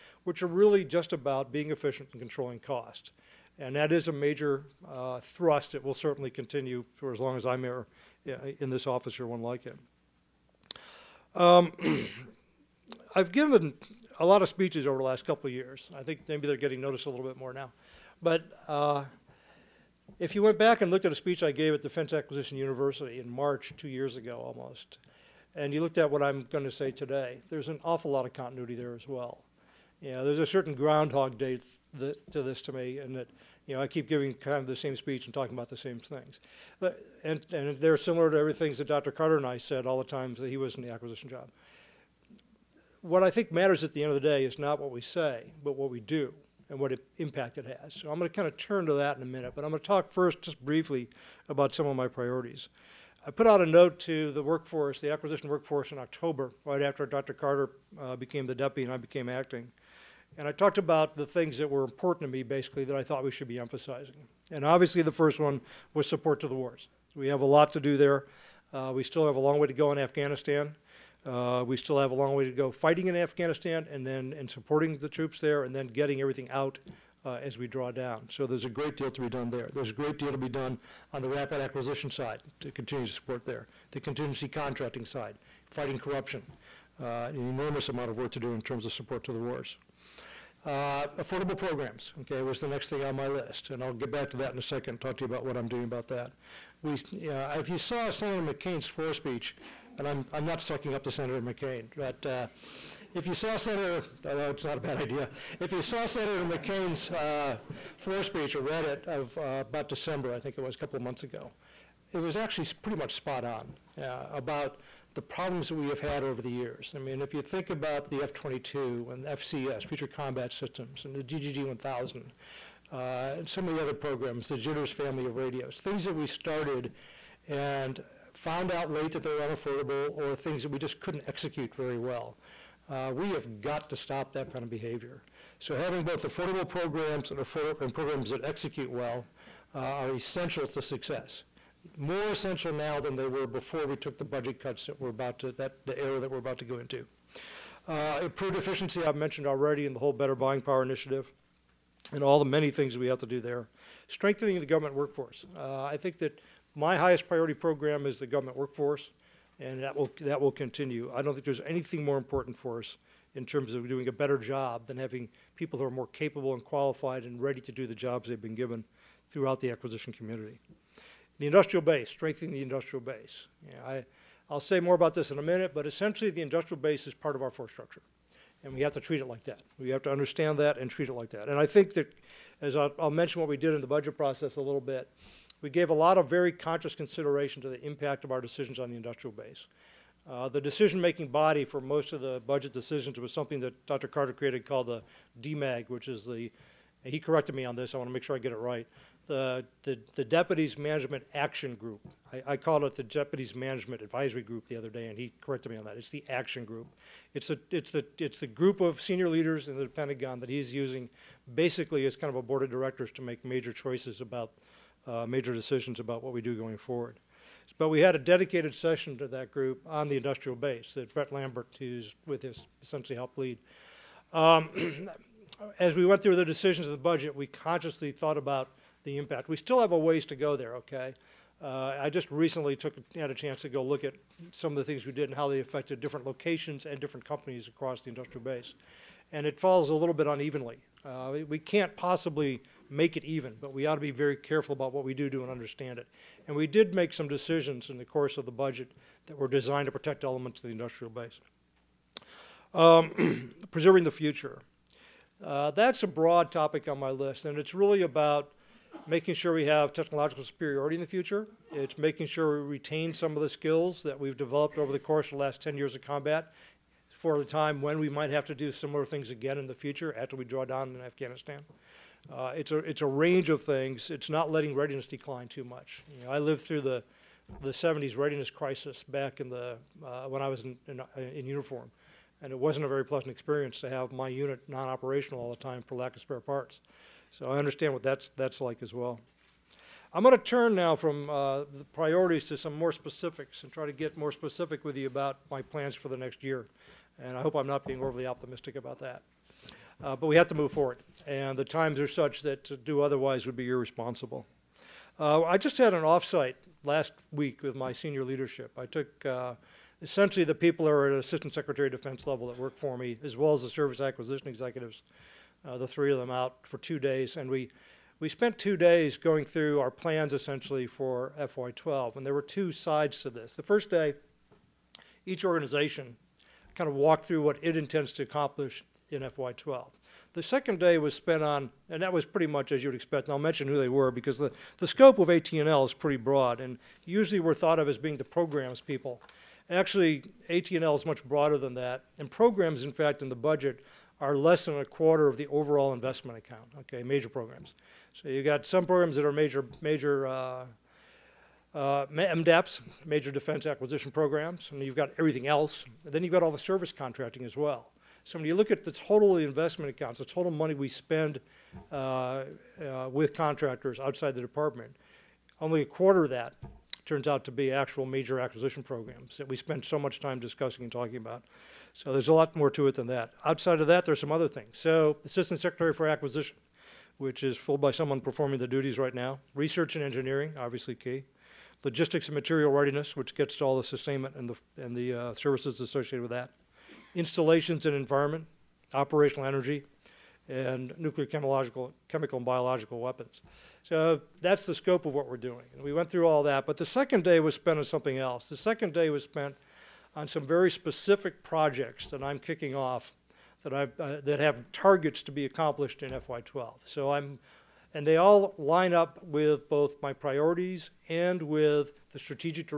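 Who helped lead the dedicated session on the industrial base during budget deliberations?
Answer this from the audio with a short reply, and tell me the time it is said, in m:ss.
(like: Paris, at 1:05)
Brett Lambert, at 3:41.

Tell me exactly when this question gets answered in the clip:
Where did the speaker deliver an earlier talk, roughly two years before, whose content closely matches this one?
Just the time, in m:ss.
0:21.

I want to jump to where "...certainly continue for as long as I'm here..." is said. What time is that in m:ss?
0:05.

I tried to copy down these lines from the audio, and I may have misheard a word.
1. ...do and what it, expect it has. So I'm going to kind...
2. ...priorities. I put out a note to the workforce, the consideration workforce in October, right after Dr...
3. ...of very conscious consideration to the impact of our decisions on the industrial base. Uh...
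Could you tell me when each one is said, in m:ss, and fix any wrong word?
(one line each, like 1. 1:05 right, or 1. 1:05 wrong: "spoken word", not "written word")
1. 0:46 wrong: "impact", not "expect"
2. 0:52 wrong: "acquisition", not "consideration"
3. 3:06 right.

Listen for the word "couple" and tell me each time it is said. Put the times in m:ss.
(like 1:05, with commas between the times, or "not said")
0:15, 1:50.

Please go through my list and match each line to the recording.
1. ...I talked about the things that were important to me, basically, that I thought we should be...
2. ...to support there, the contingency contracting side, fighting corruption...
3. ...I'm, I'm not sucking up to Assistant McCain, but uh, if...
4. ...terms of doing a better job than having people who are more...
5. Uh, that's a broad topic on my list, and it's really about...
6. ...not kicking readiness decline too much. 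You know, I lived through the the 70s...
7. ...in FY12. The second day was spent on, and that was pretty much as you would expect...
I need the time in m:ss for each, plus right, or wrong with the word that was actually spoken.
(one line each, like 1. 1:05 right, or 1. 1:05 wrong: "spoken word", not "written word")
1. 1:00 right
2. 1:23 right
3. 1:40 wrong: "Senator", not "Assistant"
4. 2:43 right
5. 4:15 right
6. 4:34 wrong: "letting", not "kicking"
7. 5:29 right.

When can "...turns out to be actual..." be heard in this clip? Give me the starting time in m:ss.
6:07.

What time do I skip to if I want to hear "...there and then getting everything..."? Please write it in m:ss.
1:15.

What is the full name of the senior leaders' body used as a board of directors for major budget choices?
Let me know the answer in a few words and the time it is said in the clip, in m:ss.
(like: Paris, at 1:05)
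Deputies Management Action Group, at 3:20.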